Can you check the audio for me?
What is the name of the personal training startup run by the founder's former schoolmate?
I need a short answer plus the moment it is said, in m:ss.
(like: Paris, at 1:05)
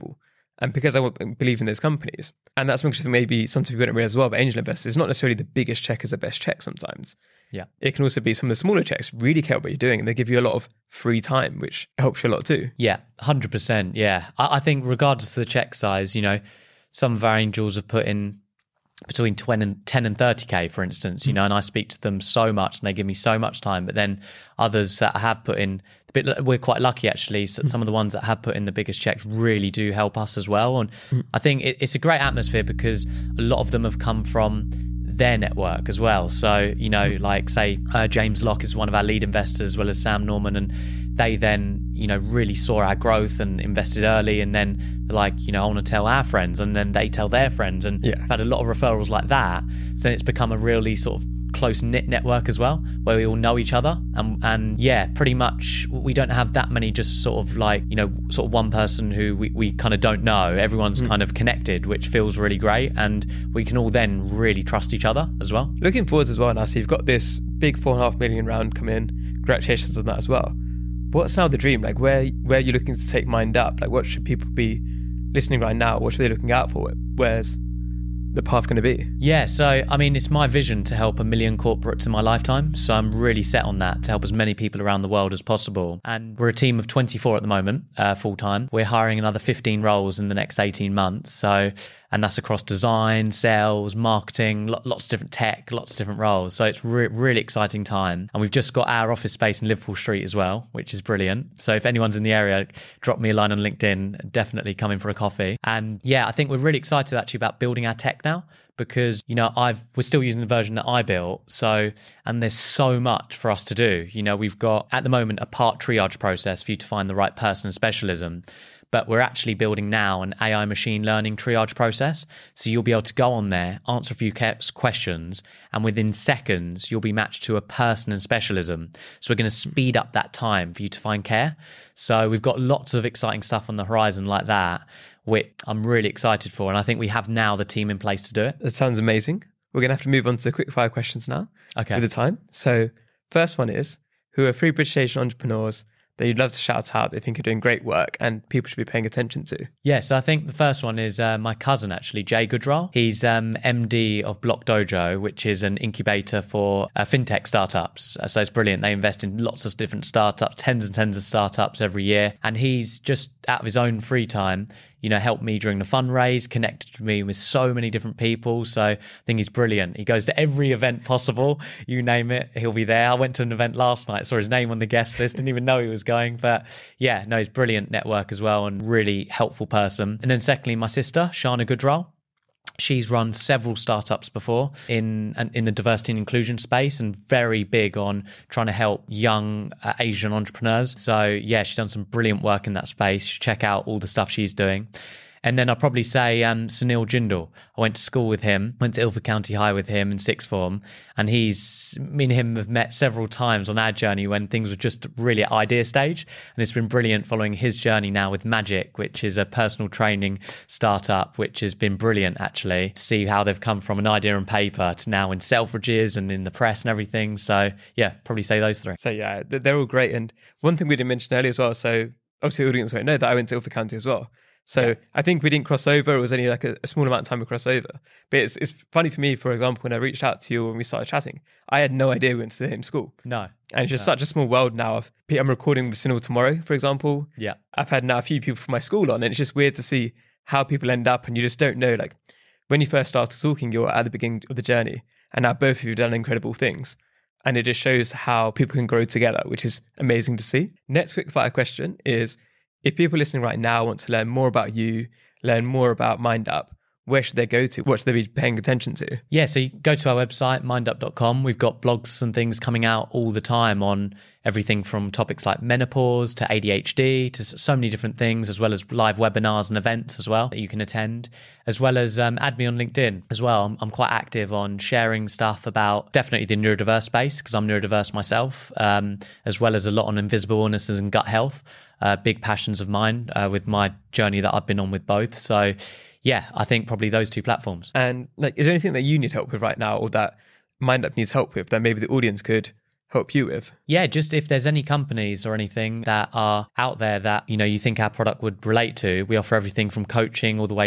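Magic, at 3:28.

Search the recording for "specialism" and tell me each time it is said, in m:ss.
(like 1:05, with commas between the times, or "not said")
1:57, 2:08.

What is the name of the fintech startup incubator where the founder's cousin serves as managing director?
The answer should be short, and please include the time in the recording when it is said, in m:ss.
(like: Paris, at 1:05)
Block Dojo, at 2:34.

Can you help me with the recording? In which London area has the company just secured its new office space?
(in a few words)
Liverpool Street.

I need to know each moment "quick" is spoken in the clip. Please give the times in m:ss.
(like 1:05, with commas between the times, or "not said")
2:20, 4:11.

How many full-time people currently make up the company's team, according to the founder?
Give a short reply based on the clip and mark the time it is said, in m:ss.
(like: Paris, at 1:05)
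24, at 1:26.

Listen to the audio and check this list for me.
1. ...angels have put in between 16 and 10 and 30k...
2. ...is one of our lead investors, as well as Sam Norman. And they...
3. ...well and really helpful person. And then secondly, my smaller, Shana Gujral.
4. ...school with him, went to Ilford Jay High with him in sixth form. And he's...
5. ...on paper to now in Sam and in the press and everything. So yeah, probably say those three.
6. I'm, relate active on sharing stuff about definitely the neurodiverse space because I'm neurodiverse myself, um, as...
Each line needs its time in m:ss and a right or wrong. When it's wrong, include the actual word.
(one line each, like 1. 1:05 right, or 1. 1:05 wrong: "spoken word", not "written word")
1. 0:17 wrong: "10", not "16"
2. 0:38 right
3. 2:58 wrong: "sister", not "smaller"
4. 3:18 wrong: "County", not "Jay"
5. 3:34 wrong: "Selfridges", not "Sam"
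6. 4:33 wrong: "quite", not "relate".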